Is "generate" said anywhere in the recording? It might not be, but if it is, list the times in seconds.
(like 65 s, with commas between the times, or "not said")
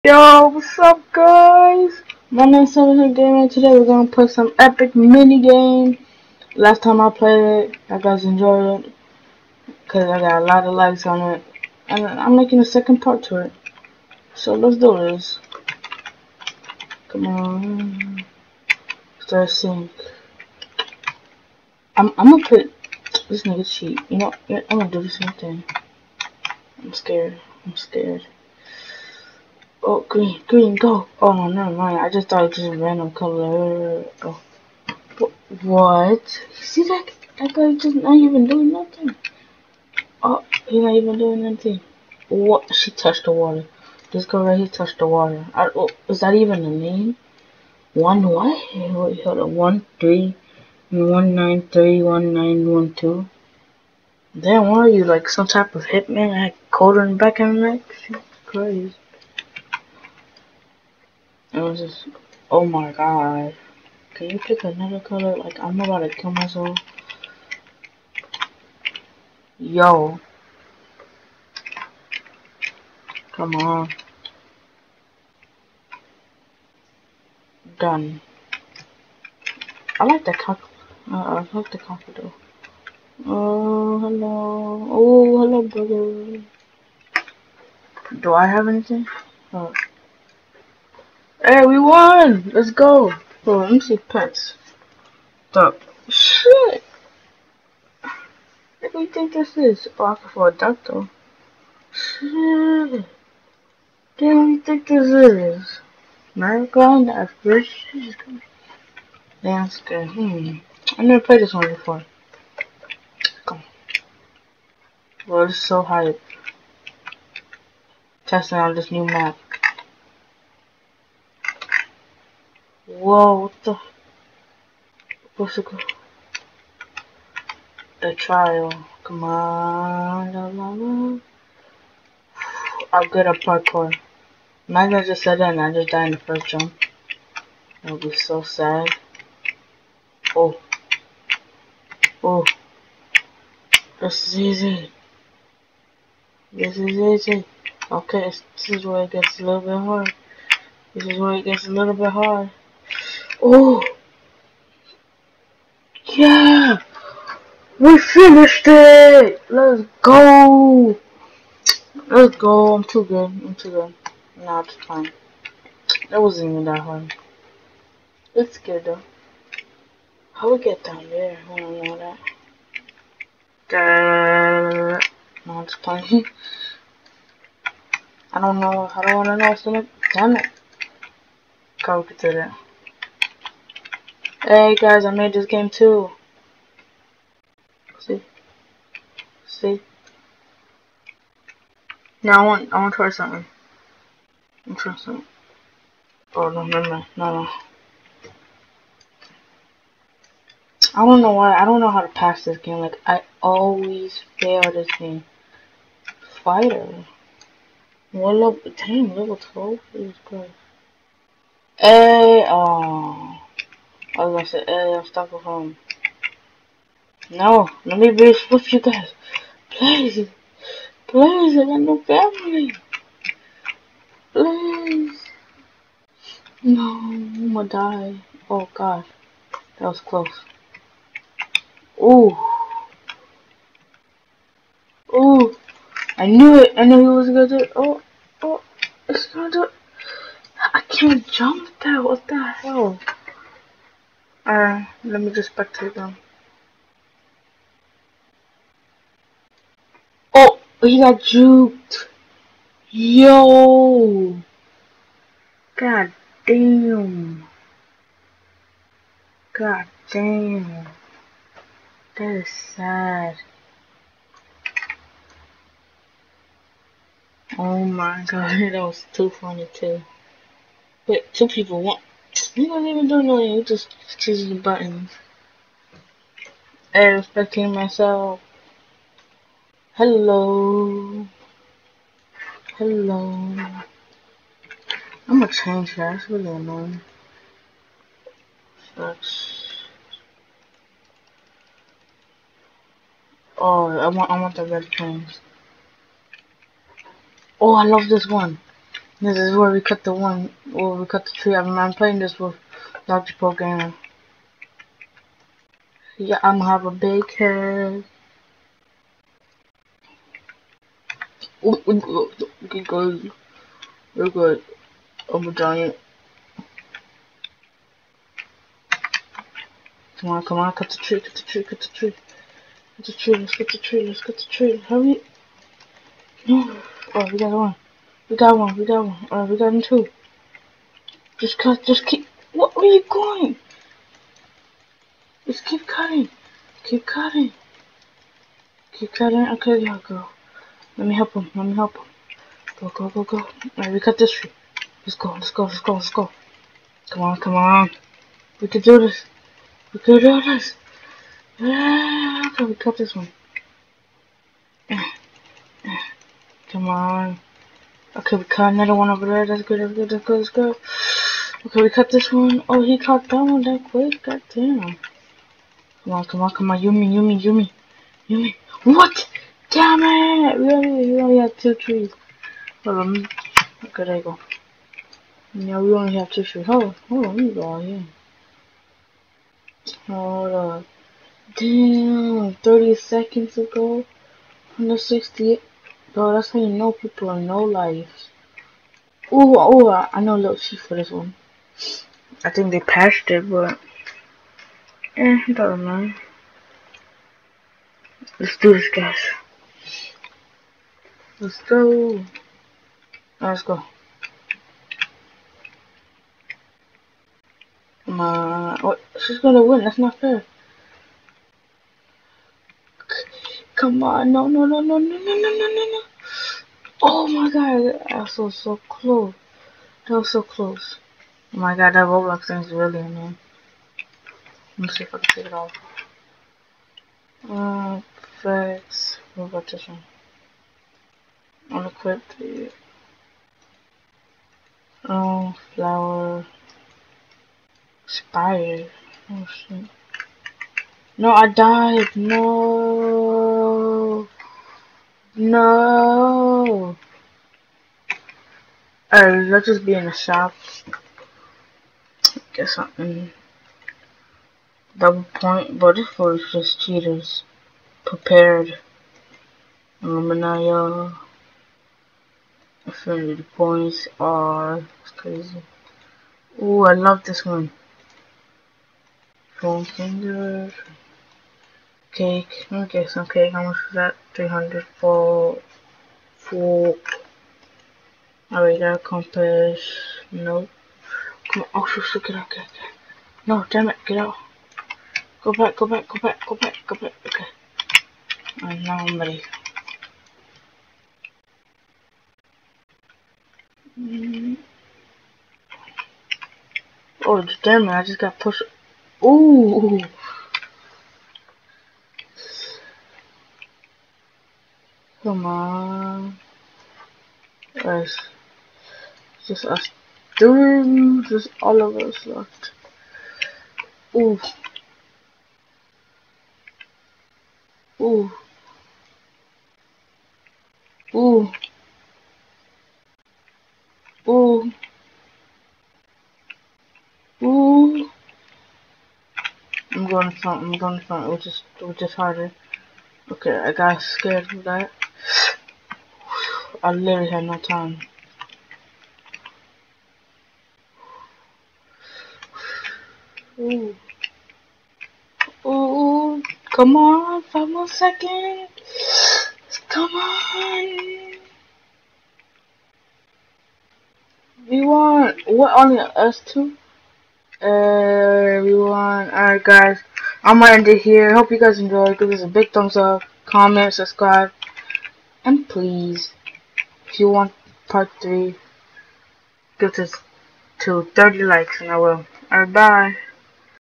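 not said.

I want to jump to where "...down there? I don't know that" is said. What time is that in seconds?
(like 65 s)
170 s.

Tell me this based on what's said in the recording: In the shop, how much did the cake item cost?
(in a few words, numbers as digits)
300.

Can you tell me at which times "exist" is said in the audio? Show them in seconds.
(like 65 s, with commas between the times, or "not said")
not said.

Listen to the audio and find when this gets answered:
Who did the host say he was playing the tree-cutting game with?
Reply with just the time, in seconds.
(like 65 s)
303 s.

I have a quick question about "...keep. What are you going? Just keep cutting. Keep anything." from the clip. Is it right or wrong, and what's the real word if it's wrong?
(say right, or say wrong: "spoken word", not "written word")
wrong: "cutting", not "anything".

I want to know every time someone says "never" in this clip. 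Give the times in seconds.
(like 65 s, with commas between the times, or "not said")
31 s, 111 s.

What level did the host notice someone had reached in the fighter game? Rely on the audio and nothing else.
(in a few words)
Level 12.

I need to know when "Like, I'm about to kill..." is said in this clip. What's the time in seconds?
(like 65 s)
65 s.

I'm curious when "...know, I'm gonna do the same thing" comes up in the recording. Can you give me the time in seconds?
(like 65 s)
24 s.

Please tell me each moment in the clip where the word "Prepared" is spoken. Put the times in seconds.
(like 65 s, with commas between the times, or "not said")
458 s.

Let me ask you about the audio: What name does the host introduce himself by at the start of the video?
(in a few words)
Seven Gaming.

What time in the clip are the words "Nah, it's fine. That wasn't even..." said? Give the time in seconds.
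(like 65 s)
164 s.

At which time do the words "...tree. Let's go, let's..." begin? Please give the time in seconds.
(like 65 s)
344 s.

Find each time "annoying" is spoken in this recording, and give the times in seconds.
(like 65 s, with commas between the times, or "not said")
286 s, 422 s.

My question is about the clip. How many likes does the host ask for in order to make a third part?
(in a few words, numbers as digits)
30.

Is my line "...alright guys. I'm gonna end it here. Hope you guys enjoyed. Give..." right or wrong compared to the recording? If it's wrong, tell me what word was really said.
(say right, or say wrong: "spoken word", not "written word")
right.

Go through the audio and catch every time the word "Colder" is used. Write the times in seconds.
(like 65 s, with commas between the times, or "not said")
56 s.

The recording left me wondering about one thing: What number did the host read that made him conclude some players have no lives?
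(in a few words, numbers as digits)
168.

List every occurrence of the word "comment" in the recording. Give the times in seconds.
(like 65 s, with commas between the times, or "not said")
563 s.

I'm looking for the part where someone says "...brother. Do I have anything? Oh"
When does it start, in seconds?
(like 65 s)
85 s.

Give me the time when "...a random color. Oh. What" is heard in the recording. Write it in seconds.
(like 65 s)
32 s.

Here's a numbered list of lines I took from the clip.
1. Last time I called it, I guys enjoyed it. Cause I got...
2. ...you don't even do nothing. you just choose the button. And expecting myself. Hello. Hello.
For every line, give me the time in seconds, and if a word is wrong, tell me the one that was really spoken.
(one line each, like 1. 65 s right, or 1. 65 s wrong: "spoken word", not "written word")
1. 6 s wrong: "played", not "called"
2. 272 s wrong: "anything", not "nothing".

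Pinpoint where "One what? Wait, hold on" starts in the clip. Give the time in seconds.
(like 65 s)
47 s.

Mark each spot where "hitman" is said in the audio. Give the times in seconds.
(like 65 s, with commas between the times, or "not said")
55 s.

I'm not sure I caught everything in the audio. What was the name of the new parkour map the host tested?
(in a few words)
The trial.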